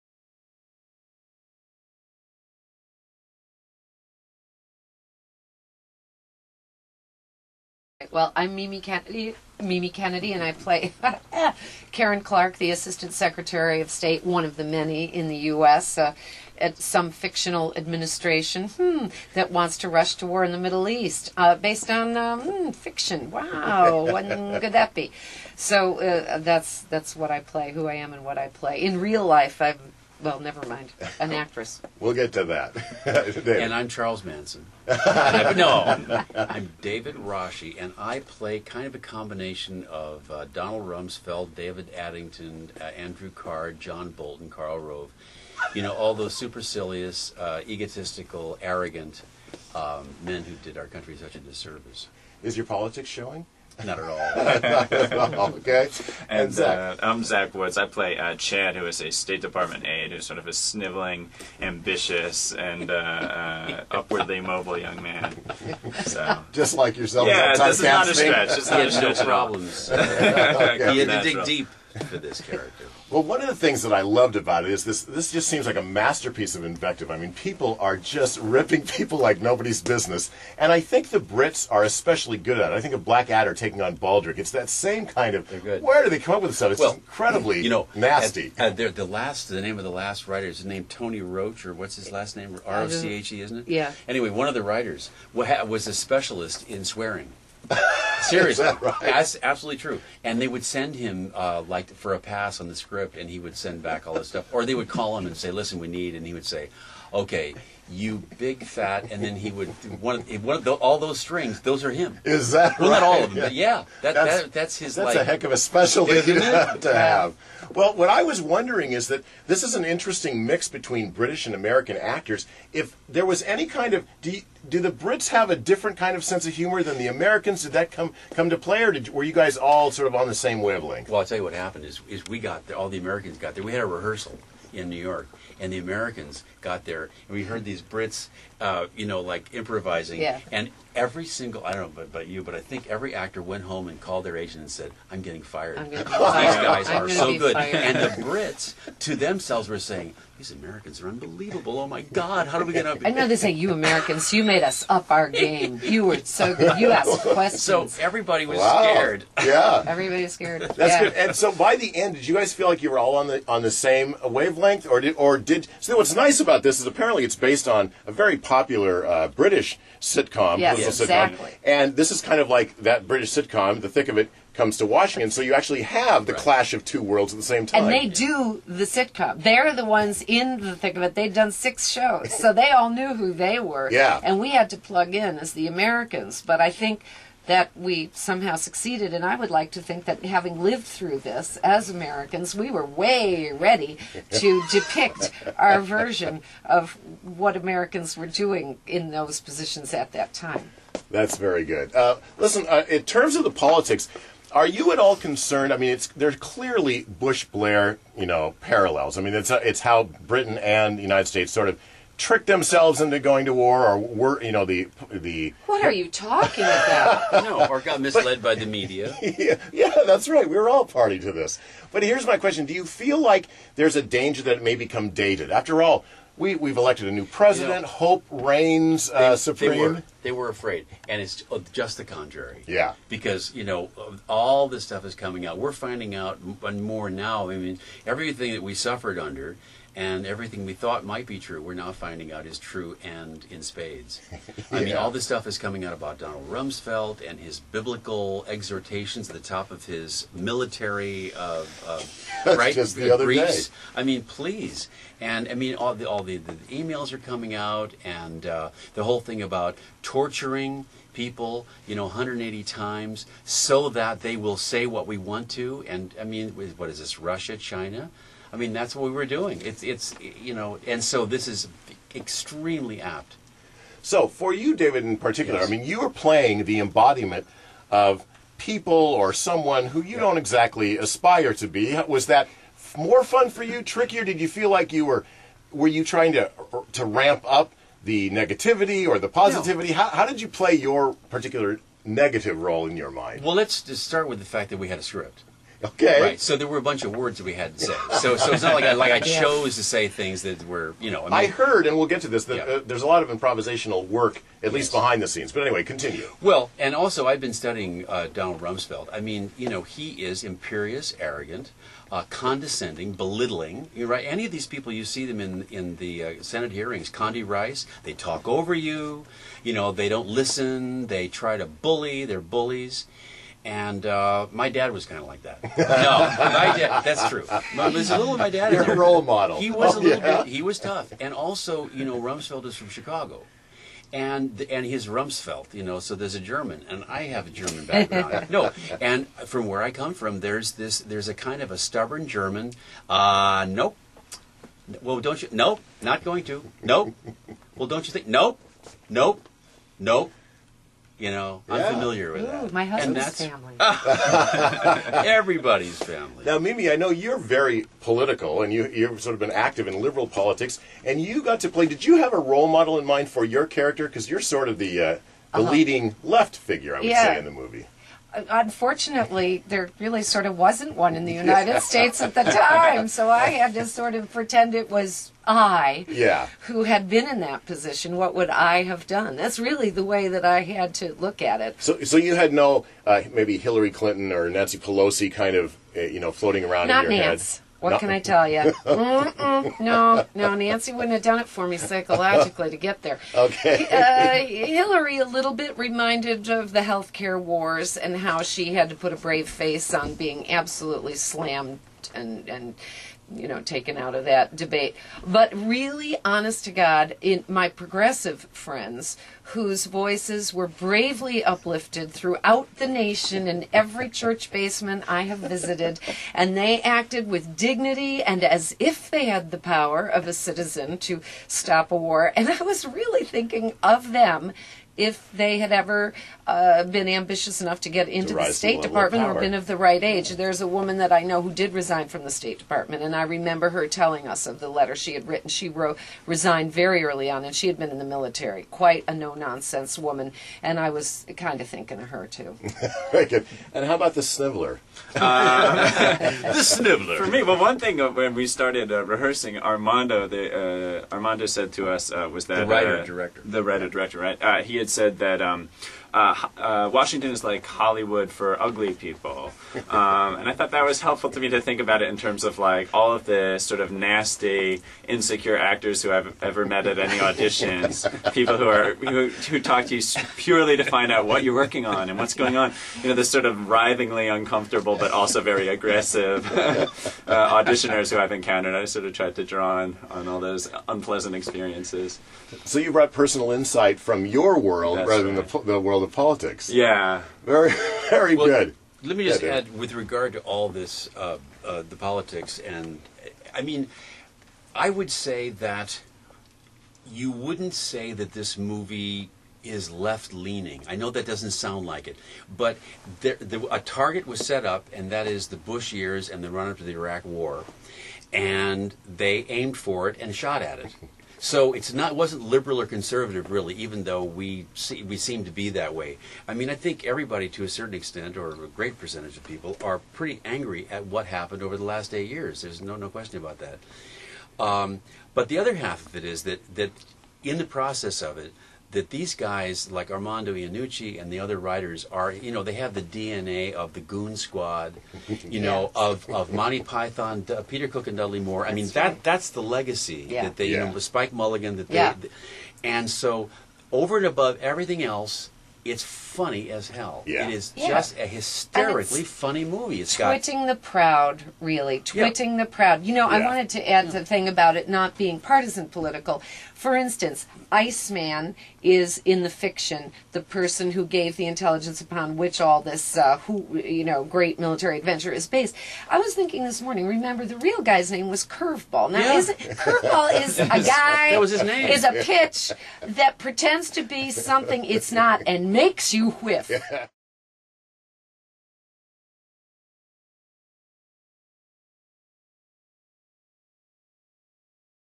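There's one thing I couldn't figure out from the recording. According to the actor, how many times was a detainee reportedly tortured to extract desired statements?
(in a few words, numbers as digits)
180.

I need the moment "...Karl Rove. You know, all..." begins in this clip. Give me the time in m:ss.
0:44.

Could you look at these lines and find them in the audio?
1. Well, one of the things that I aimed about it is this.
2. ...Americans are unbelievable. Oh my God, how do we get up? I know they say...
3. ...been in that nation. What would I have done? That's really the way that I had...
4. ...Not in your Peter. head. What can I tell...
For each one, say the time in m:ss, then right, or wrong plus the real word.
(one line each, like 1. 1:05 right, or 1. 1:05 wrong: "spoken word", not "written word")
1. 1:13 wrong: "loved", not "aimed"
2. 2:30 right
3. 6:17 wrong: "position", not "nation"
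4. 6:26 wrong: "Nance", not "Peter".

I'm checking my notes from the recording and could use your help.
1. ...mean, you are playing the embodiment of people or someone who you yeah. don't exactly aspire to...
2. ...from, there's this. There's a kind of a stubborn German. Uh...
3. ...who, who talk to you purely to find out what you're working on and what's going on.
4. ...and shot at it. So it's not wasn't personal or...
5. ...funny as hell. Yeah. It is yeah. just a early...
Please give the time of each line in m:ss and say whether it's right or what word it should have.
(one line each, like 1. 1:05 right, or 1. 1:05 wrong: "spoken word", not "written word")
1. 4:35 right
2. 5:40 right
3. 7:48 right
4. 8:30 wrong: "liberal", not "personal"
5. 9:06 wrong: "hysterically", not "early".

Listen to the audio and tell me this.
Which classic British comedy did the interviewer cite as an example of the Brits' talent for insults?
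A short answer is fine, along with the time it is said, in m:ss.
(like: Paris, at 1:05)
Blackadder, at 1:23.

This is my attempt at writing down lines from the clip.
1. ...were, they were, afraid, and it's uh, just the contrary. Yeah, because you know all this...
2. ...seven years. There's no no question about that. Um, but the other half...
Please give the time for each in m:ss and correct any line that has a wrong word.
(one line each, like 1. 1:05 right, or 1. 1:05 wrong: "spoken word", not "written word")
1. 3:49 right
2. 8:42 wrong: "eight", not "seven".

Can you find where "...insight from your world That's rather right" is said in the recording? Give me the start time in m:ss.
8:03.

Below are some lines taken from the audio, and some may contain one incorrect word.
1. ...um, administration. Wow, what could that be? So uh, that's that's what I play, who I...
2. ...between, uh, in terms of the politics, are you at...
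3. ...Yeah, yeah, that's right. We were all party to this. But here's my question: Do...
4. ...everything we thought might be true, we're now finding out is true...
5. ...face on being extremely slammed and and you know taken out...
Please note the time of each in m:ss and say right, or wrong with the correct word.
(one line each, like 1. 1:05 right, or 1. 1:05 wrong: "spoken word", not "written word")
1. 0:22 wrong: "fiction", not "administration"
2. 3:22 wrong: "listen", not "between"
3. 3:39 right
4. 4:00 right
5. 6:39 wrong: "absolutely", not "extremely".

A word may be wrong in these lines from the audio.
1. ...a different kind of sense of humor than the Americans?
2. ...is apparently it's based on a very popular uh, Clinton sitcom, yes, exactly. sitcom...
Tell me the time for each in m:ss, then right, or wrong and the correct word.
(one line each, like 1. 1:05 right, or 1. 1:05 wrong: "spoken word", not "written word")
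1. 2:05 right
2. 2:46 wrong: "British", not "Clinton".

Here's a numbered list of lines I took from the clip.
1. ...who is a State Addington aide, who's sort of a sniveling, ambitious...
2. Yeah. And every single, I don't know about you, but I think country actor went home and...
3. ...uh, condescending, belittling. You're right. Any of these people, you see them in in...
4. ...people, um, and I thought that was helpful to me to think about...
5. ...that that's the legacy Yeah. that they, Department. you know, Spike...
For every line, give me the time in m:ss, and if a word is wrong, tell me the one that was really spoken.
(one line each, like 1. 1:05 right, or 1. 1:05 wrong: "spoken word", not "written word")
1. 0:58 wrong: "Department", not "Addington"
2. 2:20 wrong: "every", not "country"
3. 5:12 right
4. 7:38 right
5. 8:59 wrong: "Yeah", not "Department".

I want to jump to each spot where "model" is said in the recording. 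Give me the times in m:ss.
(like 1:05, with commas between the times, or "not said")
5:29, 6:02.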